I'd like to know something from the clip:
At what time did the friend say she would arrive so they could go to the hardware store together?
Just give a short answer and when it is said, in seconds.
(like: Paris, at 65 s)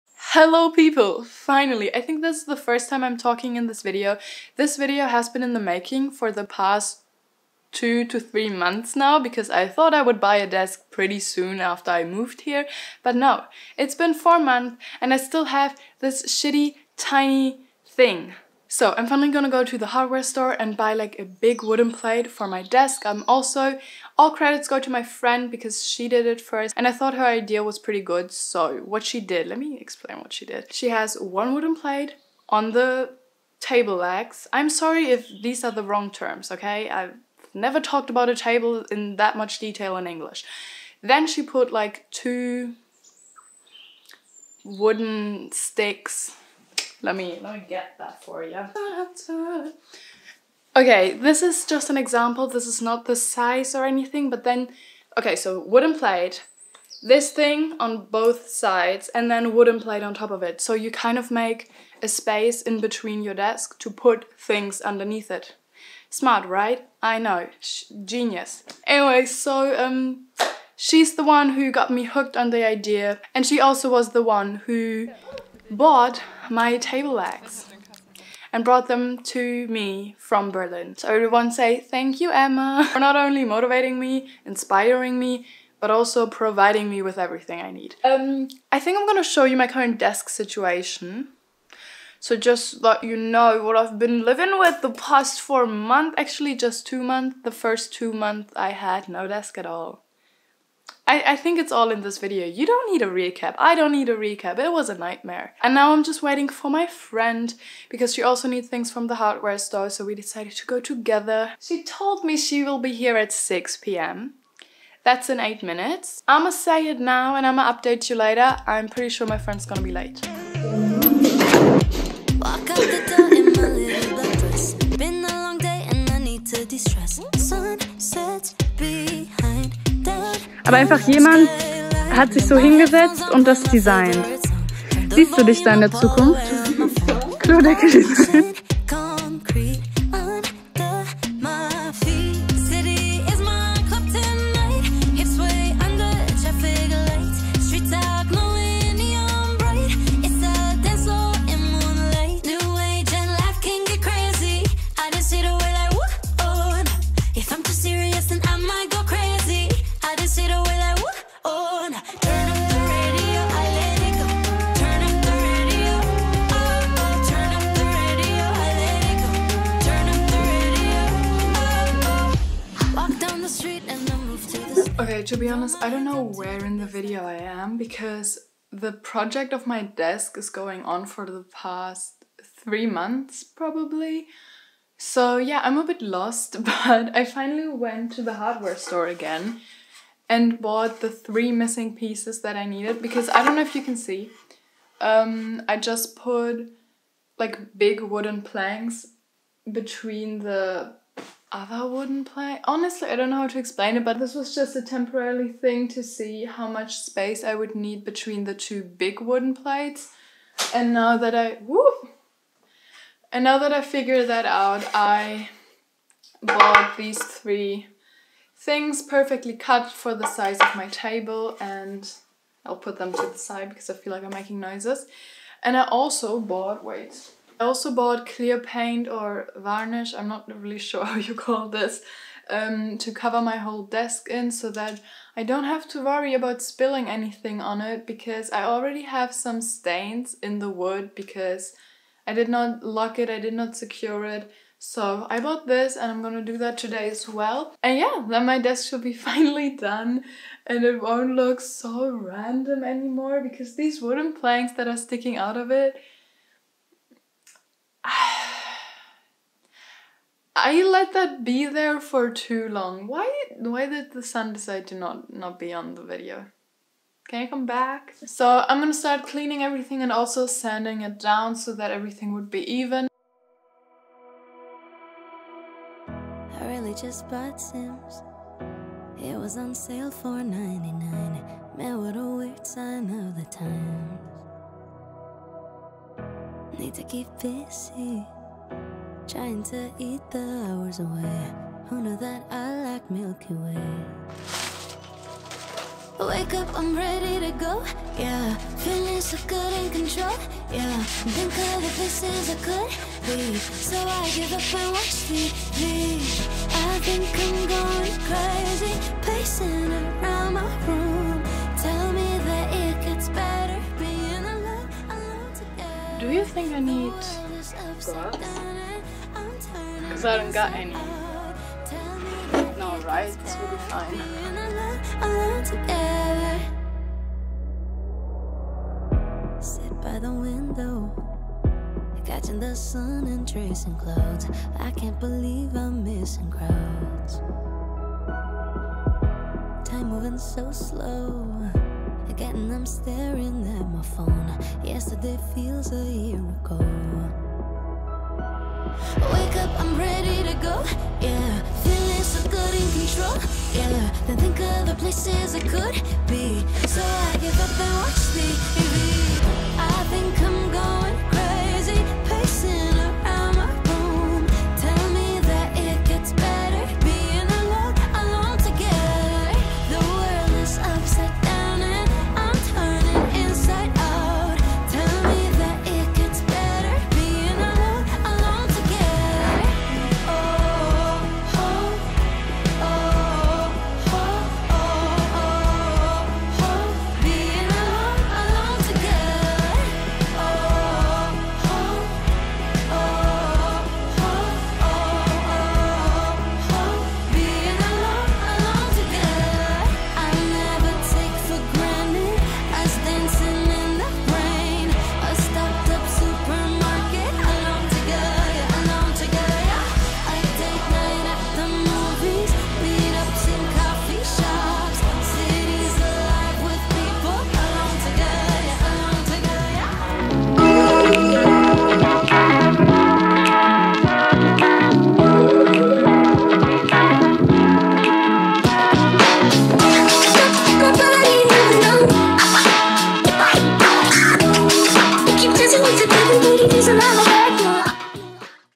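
6 p.m., at 113 s.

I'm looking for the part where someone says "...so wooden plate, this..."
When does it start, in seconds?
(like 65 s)
55 s.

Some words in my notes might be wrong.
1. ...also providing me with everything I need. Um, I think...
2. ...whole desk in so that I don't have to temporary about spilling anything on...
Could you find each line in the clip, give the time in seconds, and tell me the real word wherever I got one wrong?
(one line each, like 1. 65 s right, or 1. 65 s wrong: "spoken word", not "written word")
1. 85 s right
2. 233 s wrong: "worry", not "temporary".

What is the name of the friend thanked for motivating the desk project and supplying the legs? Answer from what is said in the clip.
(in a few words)
Emma.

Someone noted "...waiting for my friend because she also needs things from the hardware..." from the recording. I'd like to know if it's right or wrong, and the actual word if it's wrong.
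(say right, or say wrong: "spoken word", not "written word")
right.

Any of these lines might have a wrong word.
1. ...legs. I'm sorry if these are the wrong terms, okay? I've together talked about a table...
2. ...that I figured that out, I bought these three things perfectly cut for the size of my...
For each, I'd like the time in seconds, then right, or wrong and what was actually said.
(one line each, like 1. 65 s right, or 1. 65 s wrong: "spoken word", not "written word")
1. 33 s wrong: "never", not "together"
2. 213 s right.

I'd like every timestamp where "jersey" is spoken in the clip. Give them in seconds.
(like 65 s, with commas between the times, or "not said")
not said.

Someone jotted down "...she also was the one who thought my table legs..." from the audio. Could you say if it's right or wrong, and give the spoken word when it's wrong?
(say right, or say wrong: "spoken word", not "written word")
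wrong: "bought", not "thought".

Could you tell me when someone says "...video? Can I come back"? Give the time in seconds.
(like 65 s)
266 s.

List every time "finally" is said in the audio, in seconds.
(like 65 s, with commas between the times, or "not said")
1 s, 19 s, 187 s, 249 s.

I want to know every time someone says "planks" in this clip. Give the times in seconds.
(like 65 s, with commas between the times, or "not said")
198 s, 254 s.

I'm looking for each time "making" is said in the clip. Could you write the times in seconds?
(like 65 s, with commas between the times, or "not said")
5 s, 224 s.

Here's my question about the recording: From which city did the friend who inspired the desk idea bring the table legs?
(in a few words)
Berlin.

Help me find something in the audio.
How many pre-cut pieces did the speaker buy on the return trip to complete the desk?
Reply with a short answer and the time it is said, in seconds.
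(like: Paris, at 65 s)
3, at 191 s.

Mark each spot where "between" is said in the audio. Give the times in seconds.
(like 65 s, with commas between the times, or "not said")
62 s, 199 s, 208 s.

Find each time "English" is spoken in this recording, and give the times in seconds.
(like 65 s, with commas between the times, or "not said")
40 s.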